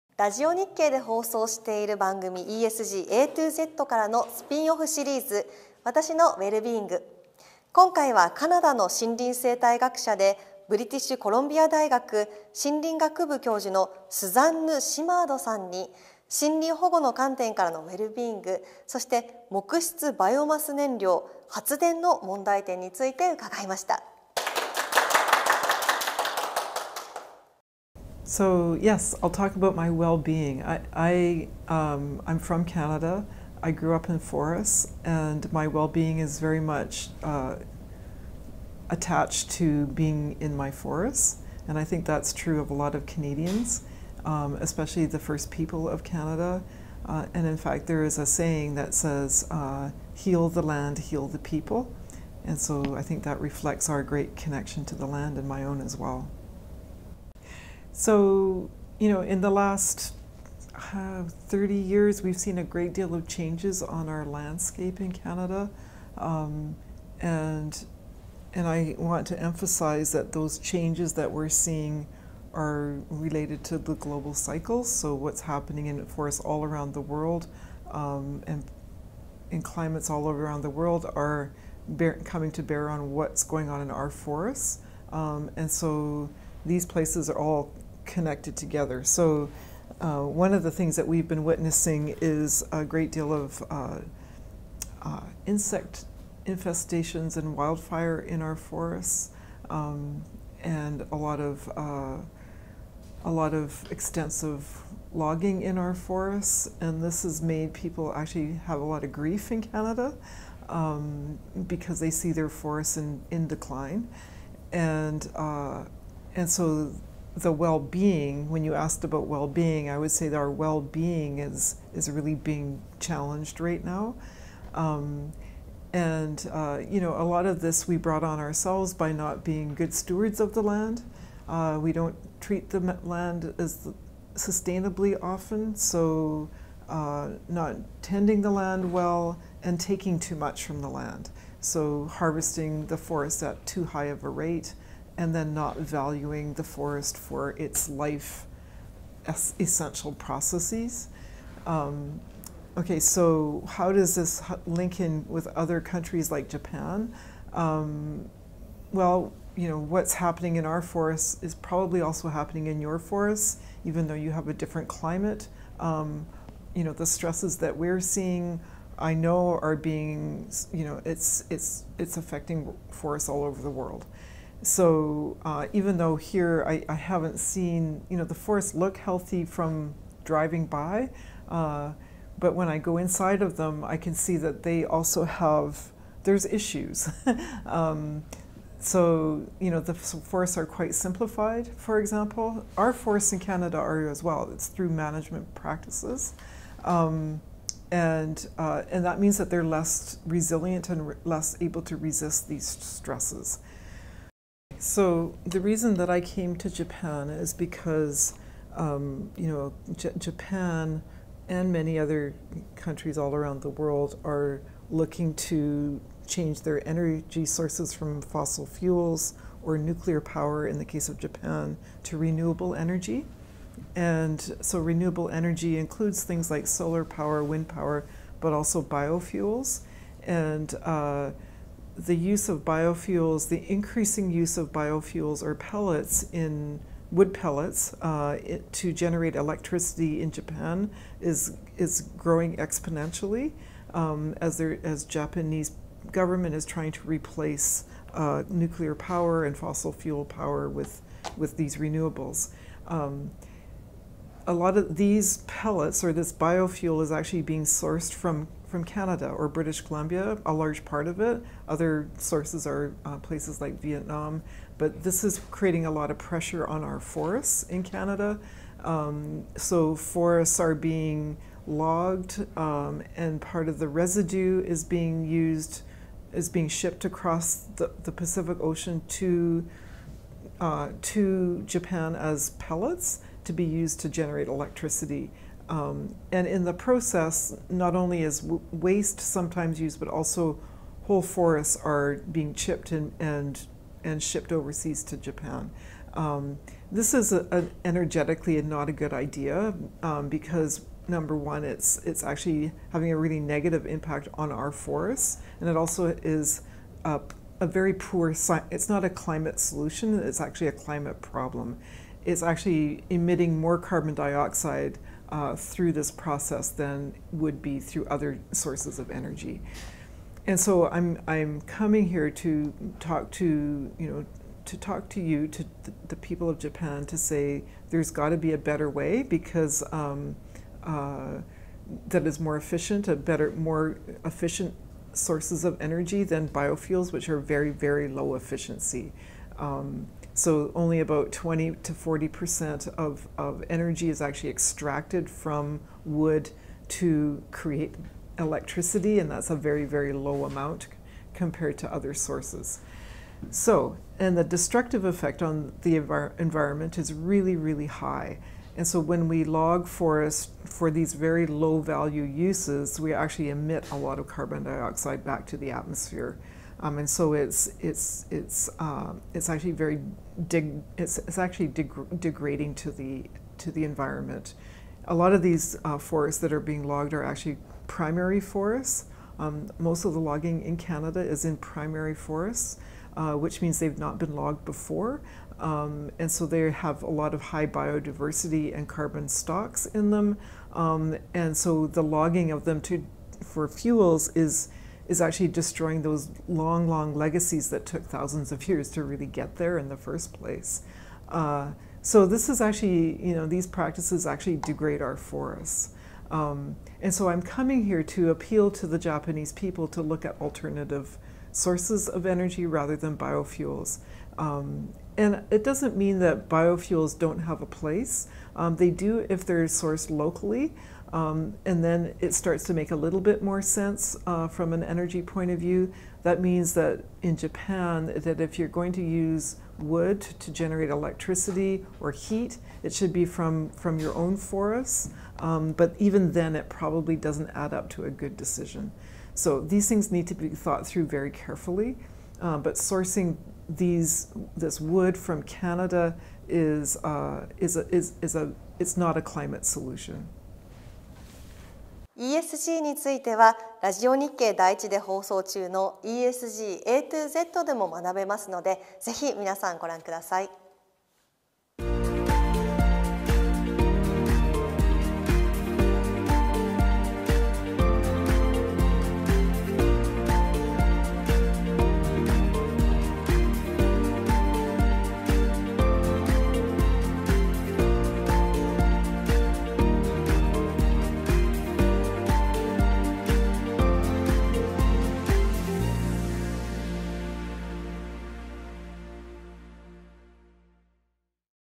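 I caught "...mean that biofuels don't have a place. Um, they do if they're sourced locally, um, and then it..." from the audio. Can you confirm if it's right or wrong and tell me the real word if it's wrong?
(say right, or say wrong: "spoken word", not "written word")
right.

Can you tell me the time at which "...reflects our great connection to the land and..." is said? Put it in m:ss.
0:53.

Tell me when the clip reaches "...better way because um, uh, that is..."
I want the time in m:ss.
5:28.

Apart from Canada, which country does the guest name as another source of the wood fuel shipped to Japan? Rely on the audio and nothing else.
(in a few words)
Vietnam.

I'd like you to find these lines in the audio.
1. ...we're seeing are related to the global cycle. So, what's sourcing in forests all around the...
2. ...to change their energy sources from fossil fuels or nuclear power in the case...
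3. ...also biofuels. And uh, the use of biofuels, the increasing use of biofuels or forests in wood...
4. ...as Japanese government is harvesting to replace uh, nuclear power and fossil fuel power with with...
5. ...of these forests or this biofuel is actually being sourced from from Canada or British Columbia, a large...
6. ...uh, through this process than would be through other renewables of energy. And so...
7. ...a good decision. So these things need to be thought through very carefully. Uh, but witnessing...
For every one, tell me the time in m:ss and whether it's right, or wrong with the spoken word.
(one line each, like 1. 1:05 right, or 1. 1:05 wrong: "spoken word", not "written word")
1. 1:11 wrong: "happening", not "sourcing"
2. 3:35 right
3. 3:48 wrong: "pellets", not "forests"
4. 4:04 wrong: "trying", not "harvesting"
5. 4:14 wrong: "pellets", not "forests"
6. 5:15 wrong: "sources", not "renewables"
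7. 7:18 wrong: "sourcing", not "witnessing".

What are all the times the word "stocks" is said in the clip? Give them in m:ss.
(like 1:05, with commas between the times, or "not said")
6:29.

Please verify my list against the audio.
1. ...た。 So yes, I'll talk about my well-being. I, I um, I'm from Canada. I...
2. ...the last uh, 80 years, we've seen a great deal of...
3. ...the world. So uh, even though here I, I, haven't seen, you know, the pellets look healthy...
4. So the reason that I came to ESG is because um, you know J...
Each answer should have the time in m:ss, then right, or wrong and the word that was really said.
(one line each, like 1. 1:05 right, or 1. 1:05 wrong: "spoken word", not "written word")
1. 0:23 right
2. 0:59 wrong: "30", not "80"
3. 2:53 wrong: "forests", not "pellets"
4. 3:24 wrong: "Japan", not "ESG".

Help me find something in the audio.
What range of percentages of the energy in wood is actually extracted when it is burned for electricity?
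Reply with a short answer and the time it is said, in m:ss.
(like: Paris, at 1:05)
20 to 40 percent, at 5:41.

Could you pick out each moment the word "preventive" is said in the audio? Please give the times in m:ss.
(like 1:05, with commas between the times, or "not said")
not said.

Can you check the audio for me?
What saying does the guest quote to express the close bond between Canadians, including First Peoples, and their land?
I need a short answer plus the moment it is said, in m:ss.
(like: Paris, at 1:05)
Heal the land, heal the people, at 0:50.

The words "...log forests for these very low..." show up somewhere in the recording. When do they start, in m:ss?
5:59.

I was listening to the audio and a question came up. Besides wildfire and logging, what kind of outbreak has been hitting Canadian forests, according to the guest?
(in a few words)
Insect infestations.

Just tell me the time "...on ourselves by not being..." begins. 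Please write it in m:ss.
2:08.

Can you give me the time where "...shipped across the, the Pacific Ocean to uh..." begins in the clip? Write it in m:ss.
4:36.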